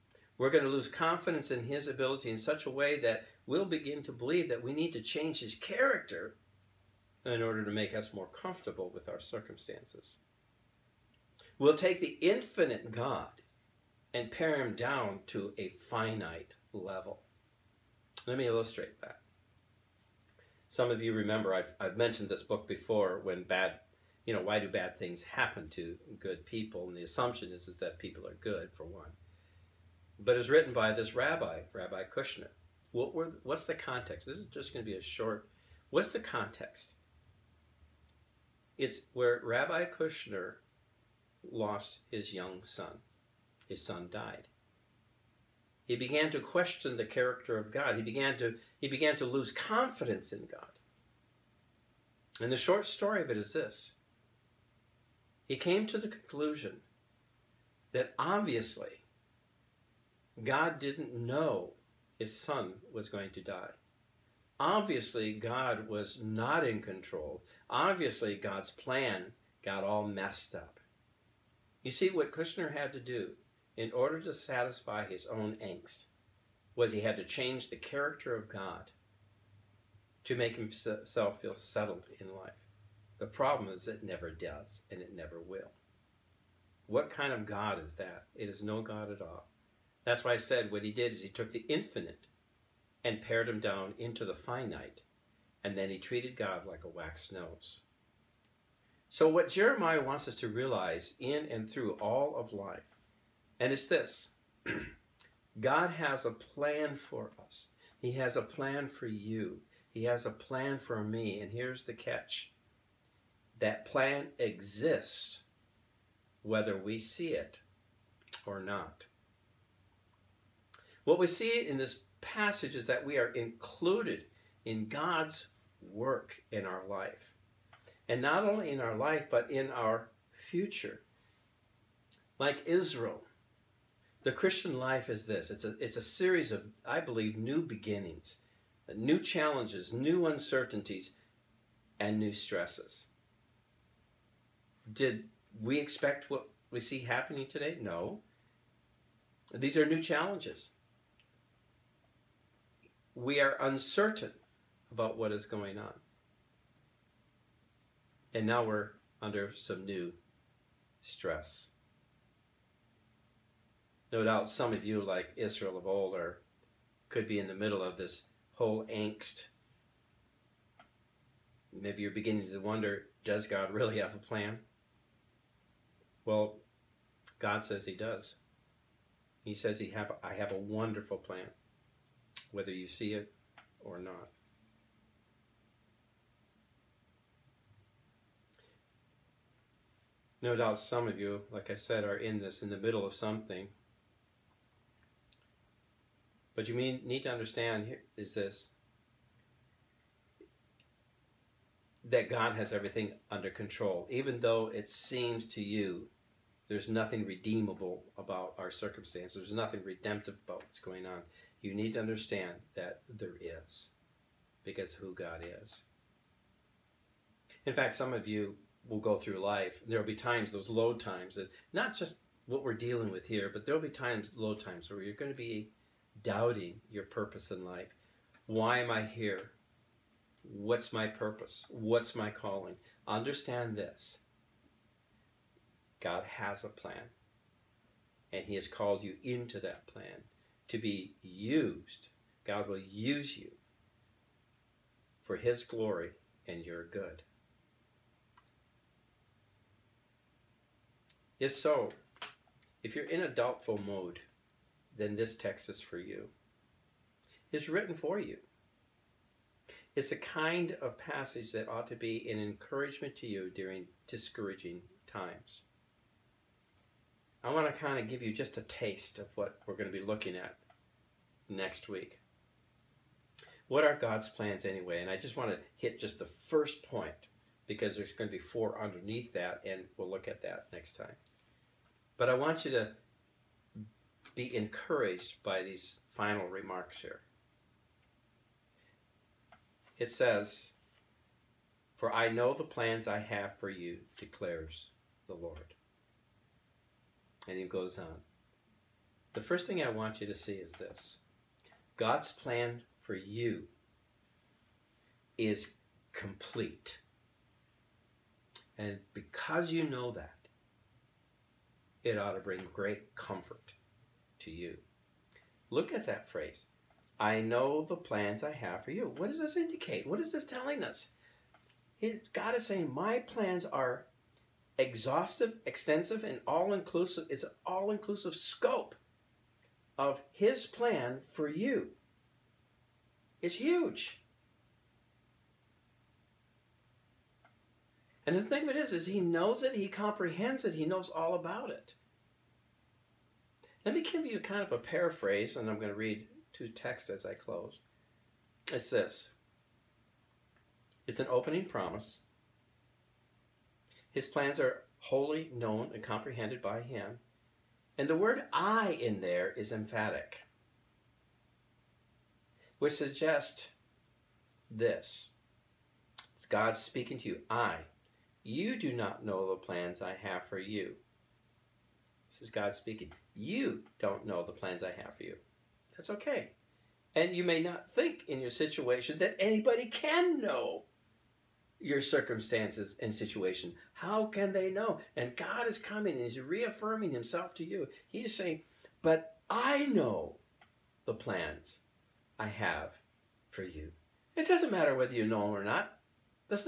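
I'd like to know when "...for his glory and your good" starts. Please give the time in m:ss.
4:05.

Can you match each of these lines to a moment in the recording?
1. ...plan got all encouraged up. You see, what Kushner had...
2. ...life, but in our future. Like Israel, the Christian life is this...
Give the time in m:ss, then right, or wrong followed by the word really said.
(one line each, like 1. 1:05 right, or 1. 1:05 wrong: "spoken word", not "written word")
1. 1:08 wrong: "messed", not "encouraged"
2. 2:08 right.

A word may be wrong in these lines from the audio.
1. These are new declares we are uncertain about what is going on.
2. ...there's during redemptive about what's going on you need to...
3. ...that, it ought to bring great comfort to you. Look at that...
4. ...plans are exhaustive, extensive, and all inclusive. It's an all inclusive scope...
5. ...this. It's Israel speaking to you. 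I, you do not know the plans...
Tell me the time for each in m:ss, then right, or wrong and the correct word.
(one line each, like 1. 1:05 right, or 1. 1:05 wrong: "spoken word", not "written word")
1. 2:29 wrong: "challenges", not "declares"
2. 3:29 wrong: "nothing", not "during"
3. 5:10 right
4. 5:23 right
5. 6:04 wrong: "God", not "Israel".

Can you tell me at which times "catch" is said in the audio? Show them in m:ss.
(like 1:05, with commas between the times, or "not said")
1:51.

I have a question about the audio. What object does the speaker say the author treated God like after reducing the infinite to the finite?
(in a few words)
a wax nose.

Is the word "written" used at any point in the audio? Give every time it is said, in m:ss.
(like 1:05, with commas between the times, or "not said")
0:30, 4:17.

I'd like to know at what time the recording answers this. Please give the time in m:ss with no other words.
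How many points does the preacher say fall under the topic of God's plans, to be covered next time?
4:38.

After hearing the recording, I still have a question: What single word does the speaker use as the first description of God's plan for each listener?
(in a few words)
complete.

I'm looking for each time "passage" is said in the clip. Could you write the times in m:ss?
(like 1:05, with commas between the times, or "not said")
2:02, 4:20.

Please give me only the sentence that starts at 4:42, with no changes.
But I want you to be encouraged by these final remarks here.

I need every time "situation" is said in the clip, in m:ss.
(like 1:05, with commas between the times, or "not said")
6:18, 6:23.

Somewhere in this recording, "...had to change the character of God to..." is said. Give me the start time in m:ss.
1:17.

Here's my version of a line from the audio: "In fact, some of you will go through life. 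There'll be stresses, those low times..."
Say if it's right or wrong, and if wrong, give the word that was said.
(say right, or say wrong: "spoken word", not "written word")
wrong: "times", not "stresses".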